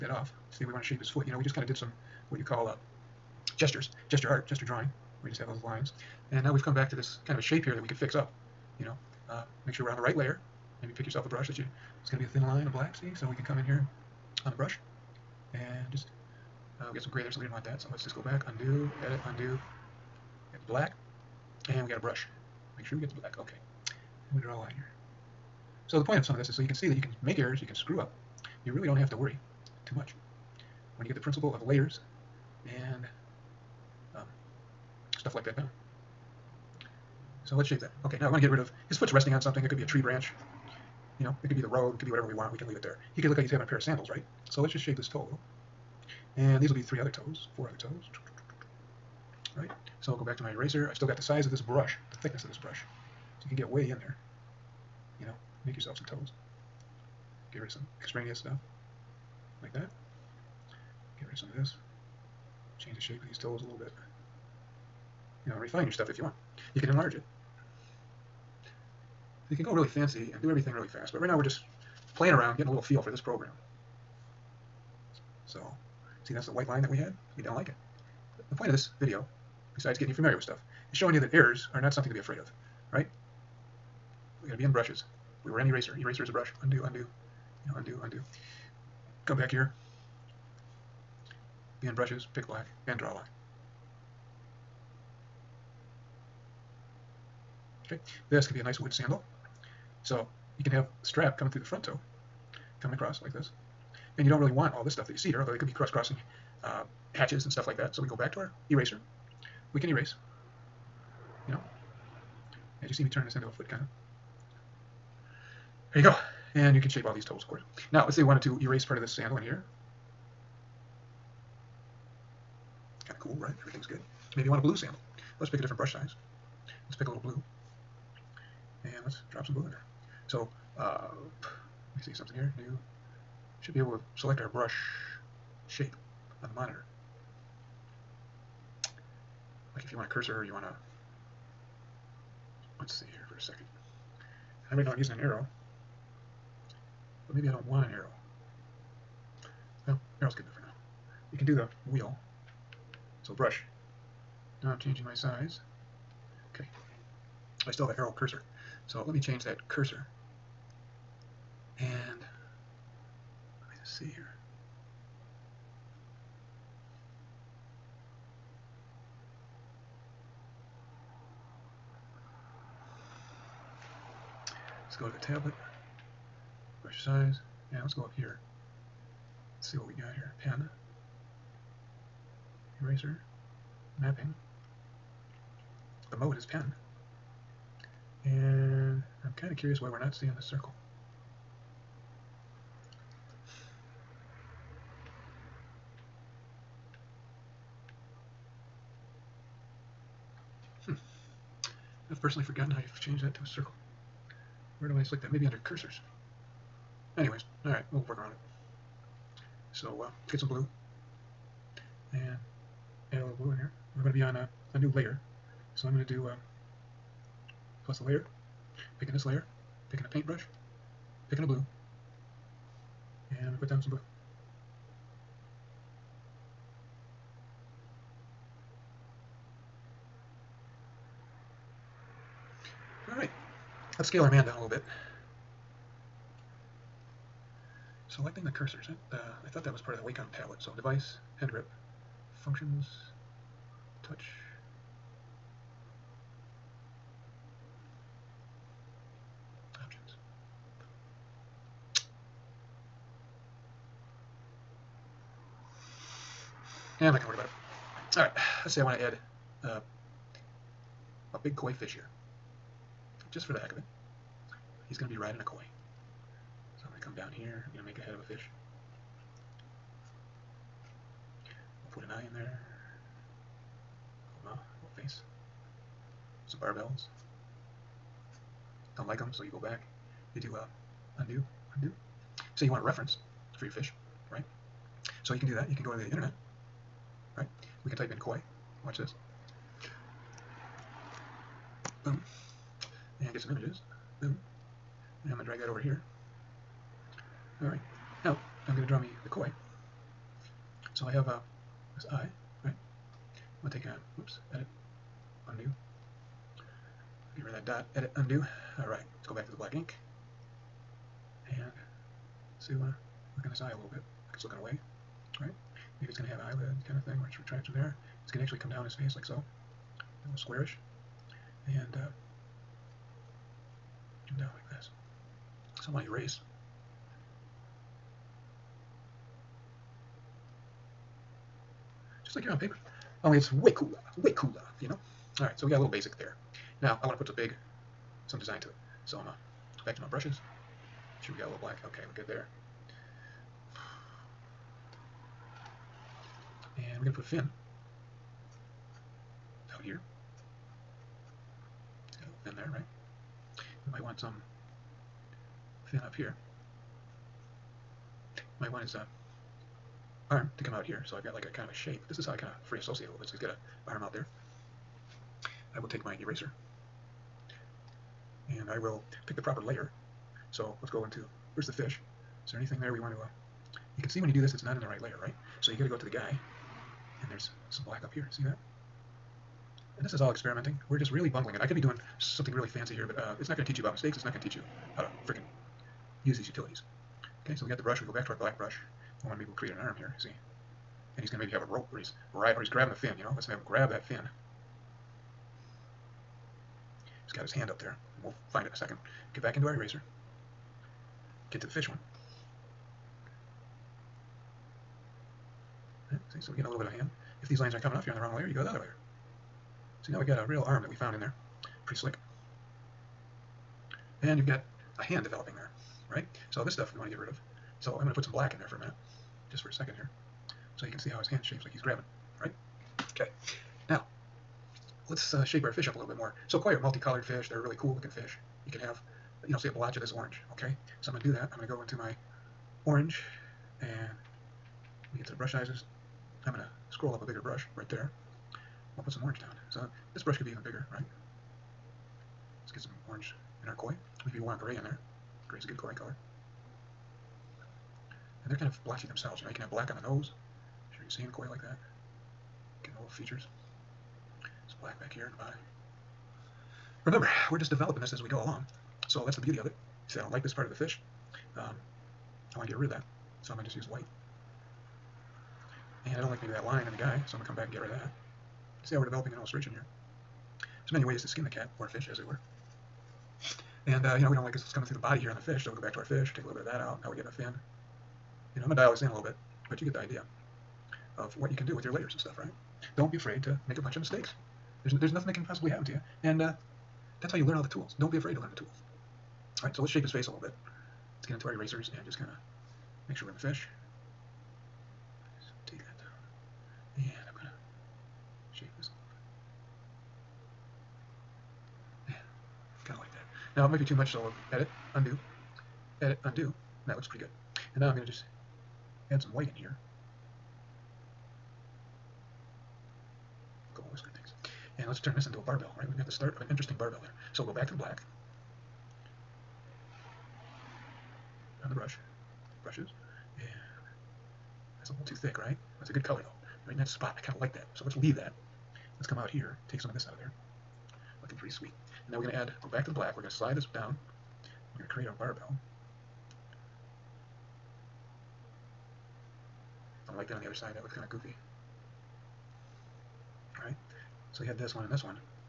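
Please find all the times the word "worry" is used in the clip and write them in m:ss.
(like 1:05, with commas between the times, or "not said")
0:29, 4:17.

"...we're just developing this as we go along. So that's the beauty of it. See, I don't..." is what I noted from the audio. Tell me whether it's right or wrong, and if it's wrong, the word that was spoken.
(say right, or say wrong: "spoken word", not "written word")
right.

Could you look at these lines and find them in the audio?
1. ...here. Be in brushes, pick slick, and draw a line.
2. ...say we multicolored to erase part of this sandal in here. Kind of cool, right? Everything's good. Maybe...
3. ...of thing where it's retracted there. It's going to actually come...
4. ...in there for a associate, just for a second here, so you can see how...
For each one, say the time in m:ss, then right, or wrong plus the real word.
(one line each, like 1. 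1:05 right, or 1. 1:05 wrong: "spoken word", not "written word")
1. 1:29 wrong: "black", not "slick"
2. 1:58 wrong: "wanted", not "multicolored"
3. 5:16 right
4. 6:58 wrong: "minute", not "associate".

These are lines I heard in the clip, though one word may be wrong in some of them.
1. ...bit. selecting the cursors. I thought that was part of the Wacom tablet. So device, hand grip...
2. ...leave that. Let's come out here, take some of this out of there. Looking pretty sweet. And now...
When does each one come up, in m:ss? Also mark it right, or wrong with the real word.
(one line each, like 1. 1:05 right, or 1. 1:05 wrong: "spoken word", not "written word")
1. 3:54 right
2. 8:47 right.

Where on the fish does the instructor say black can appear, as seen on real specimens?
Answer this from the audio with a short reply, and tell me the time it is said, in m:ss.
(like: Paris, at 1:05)
On the nose, at 7:29.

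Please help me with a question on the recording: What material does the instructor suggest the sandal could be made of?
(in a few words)
Wood.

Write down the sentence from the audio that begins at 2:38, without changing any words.
So let me change that cursor.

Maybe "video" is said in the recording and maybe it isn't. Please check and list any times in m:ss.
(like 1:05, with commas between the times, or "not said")
1:19.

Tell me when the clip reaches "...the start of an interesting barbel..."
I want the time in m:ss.
8:36.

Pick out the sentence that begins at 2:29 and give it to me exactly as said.
Well, arrow's good enough for now.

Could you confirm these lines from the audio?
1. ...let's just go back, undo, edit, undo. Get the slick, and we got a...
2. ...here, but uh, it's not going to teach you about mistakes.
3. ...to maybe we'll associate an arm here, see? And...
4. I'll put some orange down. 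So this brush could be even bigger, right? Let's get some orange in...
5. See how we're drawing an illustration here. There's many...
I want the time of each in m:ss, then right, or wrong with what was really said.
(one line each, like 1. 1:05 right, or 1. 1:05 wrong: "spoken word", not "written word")
1. 0:17 wrong: "black", not "slick"
2. 6:22 right
3. 6:29 wrong: "create", not "associate"
4. 7:18 right
5. 7:48 wrong: "developing", not "drawing".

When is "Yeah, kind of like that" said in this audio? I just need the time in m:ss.
8:22.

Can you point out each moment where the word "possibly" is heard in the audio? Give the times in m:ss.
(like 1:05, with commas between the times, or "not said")
8:05.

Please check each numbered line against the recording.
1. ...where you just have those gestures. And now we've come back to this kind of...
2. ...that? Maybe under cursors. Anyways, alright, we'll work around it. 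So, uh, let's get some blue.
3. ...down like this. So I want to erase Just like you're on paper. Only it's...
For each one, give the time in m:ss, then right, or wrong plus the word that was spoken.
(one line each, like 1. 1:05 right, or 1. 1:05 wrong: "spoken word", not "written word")
1. 0:05 wrong: "lines", not "gestures"
2. 3:25 right
3. 5:24 right.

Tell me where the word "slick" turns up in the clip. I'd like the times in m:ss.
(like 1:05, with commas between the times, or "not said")
6:51.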